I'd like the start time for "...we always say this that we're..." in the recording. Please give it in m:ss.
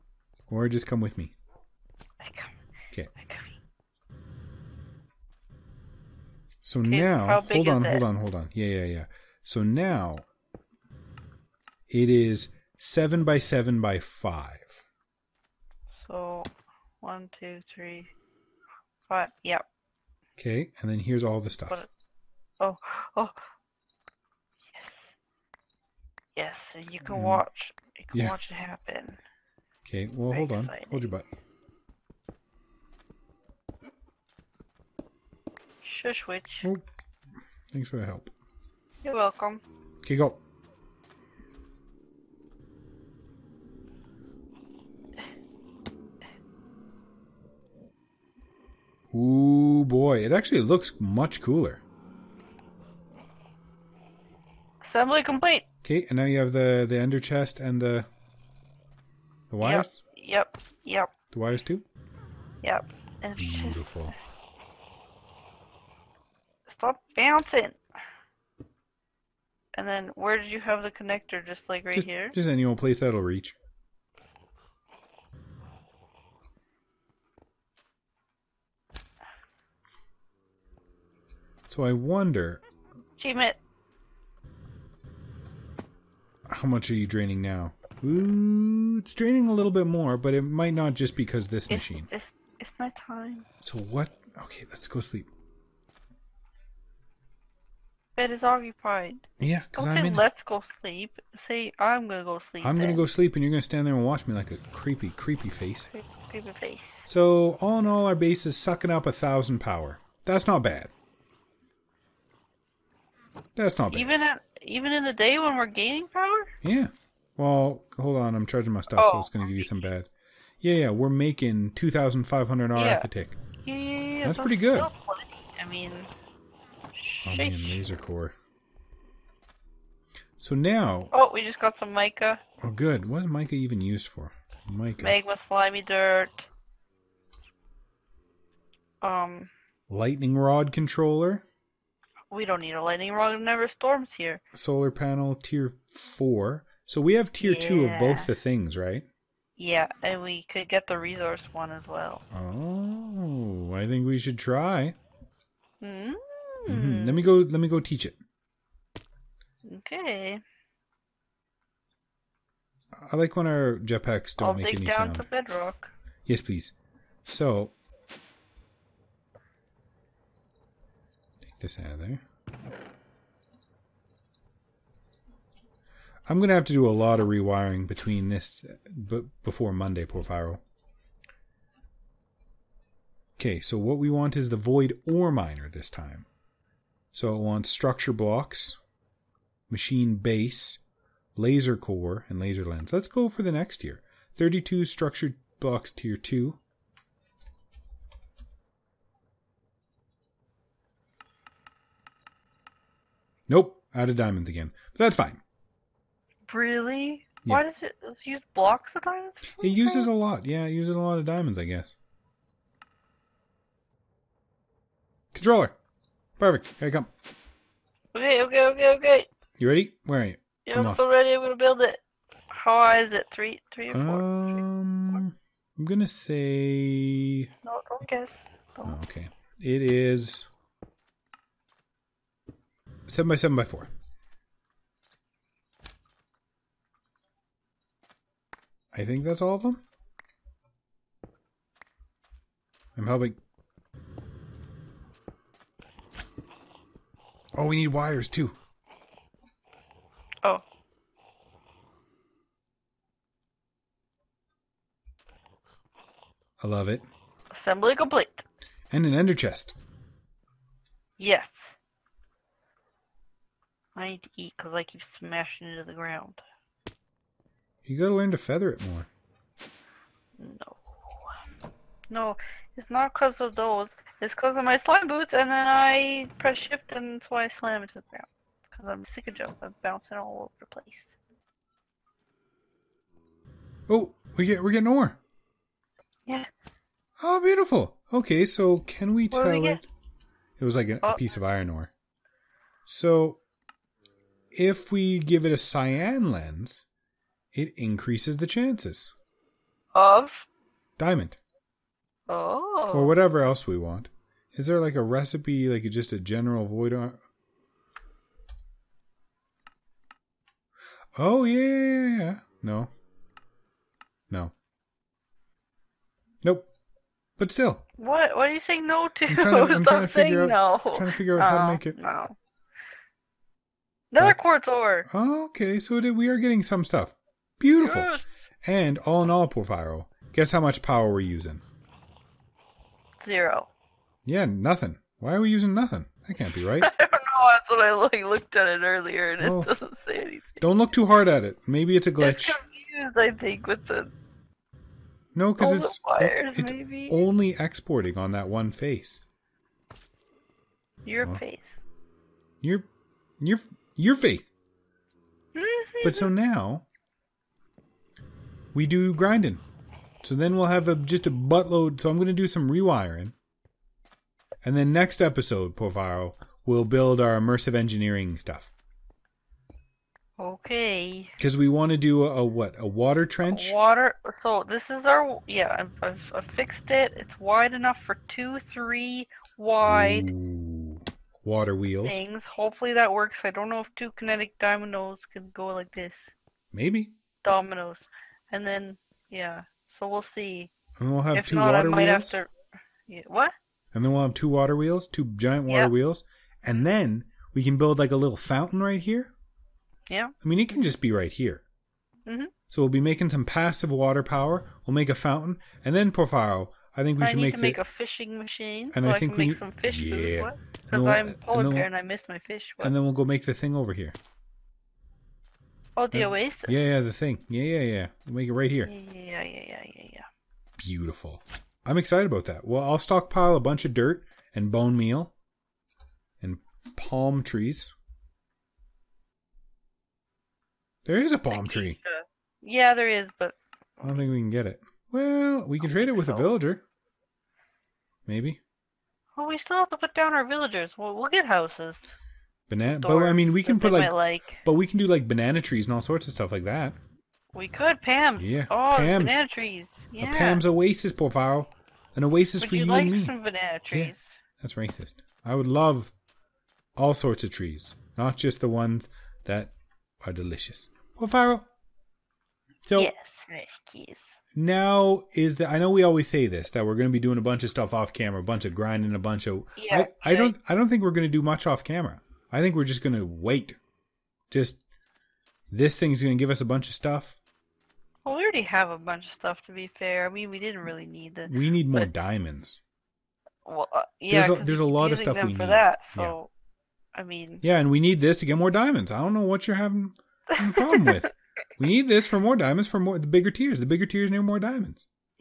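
7:45.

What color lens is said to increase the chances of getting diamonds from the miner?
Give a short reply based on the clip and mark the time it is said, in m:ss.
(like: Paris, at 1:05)
Cyan, at 4:55.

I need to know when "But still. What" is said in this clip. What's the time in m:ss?
5:17.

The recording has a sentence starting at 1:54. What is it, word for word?
Even at, even in the day when we're gaining power.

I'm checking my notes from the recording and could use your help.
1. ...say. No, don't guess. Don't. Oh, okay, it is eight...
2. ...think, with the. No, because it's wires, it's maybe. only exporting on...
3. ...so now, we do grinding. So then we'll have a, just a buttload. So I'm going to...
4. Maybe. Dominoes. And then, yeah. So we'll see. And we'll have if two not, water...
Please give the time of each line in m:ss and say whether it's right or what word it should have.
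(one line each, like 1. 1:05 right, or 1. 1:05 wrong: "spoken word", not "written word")
1. 3:46 wrong: "seven", not "eight"
2. 5:43 right
3. 5:56 right
4. 6:26 right.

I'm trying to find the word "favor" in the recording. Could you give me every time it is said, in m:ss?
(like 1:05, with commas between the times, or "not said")
7:31, 7:41.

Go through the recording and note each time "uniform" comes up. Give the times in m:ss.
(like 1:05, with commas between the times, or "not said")
not said.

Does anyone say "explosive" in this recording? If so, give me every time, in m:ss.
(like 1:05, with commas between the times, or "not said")
not said.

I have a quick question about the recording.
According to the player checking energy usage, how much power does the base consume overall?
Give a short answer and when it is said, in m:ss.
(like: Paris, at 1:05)
1000, at 1:49.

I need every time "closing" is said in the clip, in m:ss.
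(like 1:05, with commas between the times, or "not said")
not said.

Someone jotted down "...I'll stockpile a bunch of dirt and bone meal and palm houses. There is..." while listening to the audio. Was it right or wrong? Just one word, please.
wrong.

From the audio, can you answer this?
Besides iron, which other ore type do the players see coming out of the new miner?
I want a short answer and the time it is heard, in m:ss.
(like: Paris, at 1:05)
Quartz ore, at 5:24.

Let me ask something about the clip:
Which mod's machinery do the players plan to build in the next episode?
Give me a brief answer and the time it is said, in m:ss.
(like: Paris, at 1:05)
Immersive Engineering, at 6:07.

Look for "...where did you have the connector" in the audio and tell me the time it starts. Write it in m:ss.
1:10.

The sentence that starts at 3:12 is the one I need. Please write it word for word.
Let's go for the next tier.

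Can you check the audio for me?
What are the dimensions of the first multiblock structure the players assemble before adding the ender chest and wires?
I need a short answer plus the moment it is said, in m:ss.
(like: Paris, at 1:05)
7 by 7 by 5, at 0:12.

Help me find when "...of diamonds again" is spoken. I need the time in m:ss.
3:24.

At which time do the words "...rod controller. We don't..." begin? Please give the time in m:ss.
2:20.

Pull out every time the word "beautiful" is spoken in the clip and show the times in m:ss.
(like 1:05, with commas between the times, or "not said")
1:03, 4:47, 5:27, 7:00.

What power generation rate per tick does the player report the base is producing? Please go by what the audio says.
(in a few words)
2500 RF.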